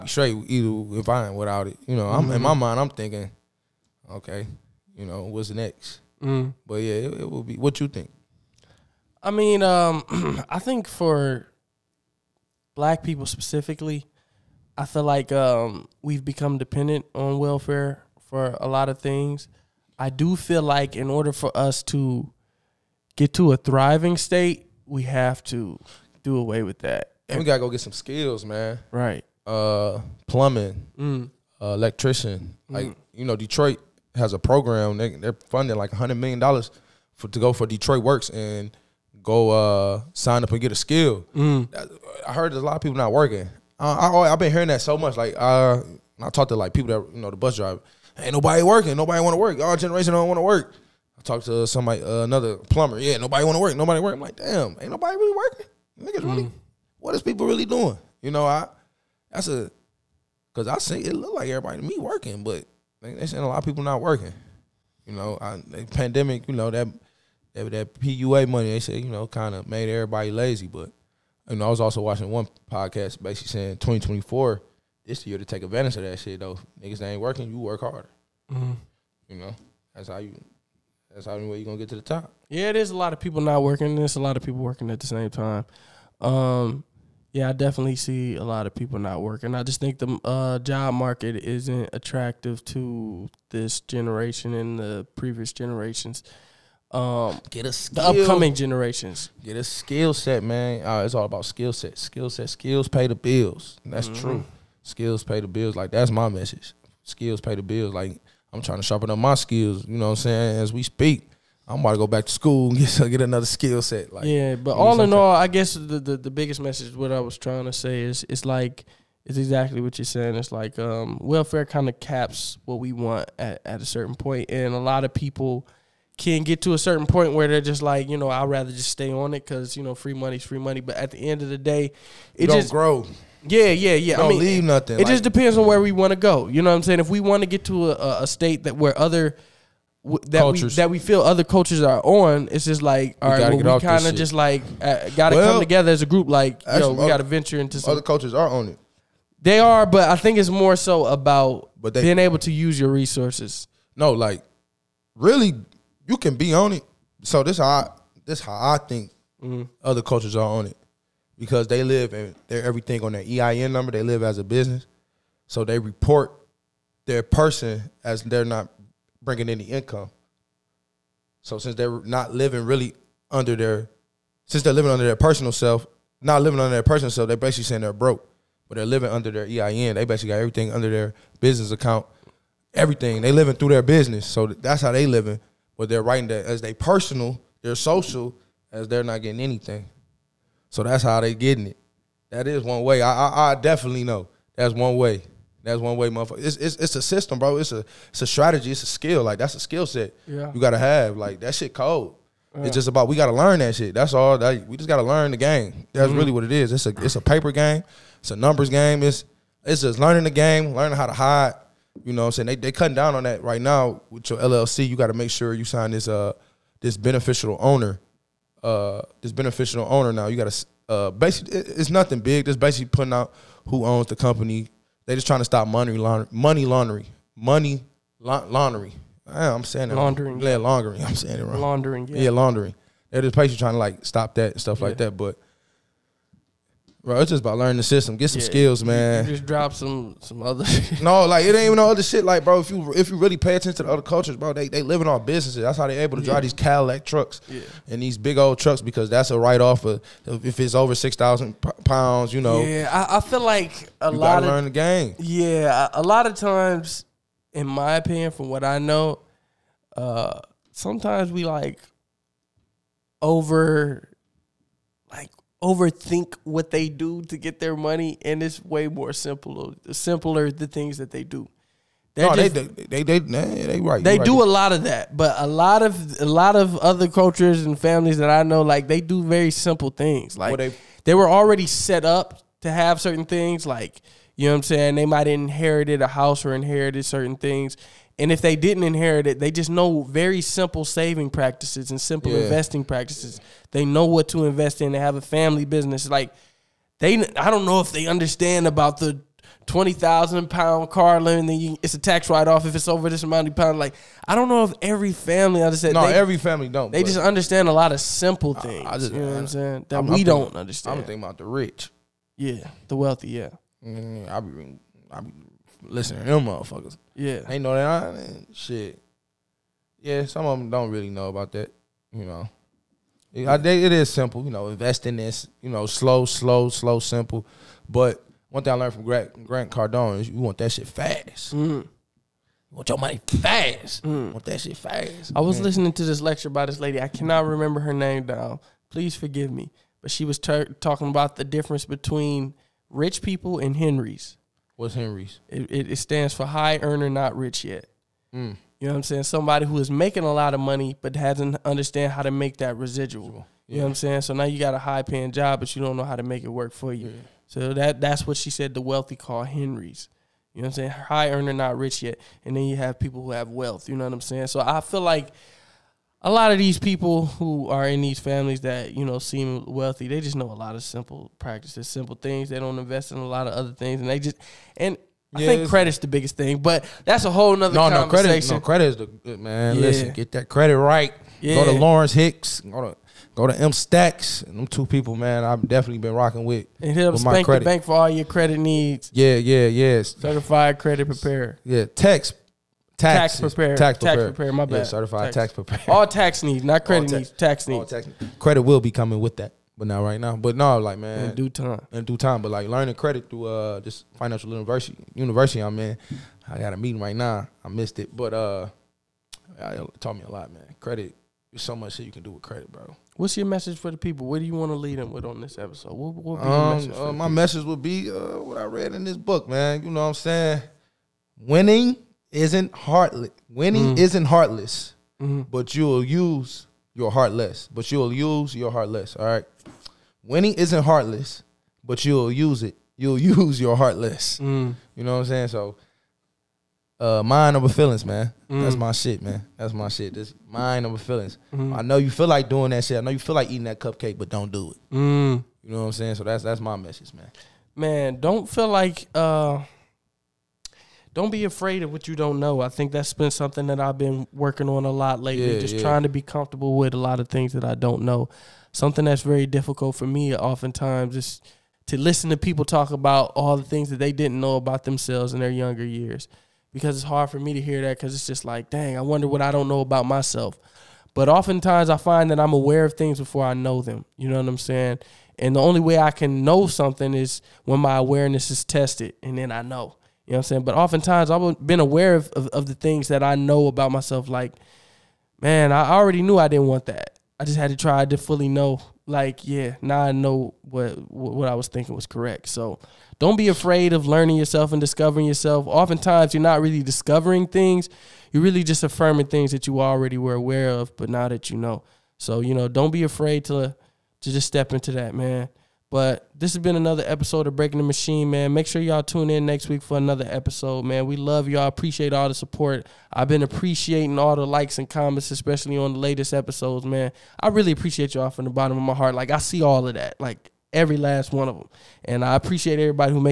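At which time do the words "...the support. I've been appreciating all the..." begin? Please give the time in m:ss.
8:32.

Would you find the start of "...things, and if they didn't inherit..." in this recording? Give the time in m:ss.
4:47.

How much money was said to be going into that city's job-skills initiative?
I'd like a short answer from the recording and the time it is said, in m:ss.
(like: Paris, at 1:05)
100 million dollars, at 0:35.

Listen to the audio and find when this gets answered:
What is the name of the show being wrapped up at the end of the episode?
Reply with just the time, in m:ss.
8:27.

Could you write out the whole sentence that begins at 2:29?
They are, but I think it's more so about but they, being able to use your resources.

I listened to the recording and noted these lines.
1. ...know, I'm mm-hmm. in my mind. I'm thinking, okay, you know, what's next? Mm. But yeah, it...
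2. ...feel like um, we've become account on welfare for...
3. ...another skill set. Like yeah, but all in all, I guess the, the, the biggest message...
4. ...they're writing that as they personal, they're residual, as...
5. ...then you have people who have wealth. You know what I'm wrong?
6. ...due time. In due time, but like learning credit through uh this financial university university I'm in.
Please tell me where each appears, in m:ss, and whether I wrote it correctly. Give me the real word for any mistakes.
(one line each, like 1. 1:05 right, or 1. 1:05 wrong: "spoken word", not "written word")
1. 0:01 right
2. 0:14 wrong: "dependent", not "account"
3. 1:53 right
4. 3:05 wrong: "social", not "residual"
5. 6:02 wrong: "saying", not "wrong"
6. 6:41 right.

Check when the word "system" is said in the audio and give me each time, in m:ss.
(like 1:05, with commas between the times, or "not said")
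3:17, 3:57.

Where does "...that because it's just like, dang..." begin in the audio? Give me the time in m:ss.
7:47.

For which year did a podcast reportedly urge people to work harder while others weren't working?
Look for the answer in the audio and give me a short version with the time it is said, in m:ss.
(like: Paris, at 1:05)
2024, at 1:13.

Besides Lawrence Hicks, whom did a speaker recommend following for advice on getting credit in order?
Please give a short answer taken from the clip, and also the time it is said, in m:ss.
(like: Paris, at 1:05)
M Stacks, at 6:23.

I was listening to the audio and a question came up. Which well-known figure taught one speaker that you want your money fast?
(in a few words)
Grant Cardone.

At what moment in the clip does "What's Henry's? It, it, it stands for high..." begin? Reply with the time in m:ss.
5:44.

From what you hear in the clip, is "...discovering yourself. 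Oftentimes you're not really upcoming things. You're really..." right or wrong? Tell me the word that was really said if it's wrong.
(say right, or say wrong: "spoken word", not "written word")
wrong: "discovering", not "upcoming".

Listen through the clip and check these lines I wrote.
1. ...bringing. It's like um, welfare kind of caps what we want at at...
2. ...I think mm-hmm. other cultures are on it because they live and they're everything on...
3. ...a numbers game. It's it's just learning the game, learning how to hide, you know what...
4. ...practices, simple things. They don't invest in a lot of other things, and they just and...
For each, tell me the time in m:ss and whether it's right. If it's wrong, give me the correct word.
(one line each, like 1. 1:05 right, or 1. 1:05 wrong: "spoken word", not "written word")
1. 2:00 wrong: "saying", not "bringing"
2. 2:38 right
3. 3:28 right
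4. 6:11 right.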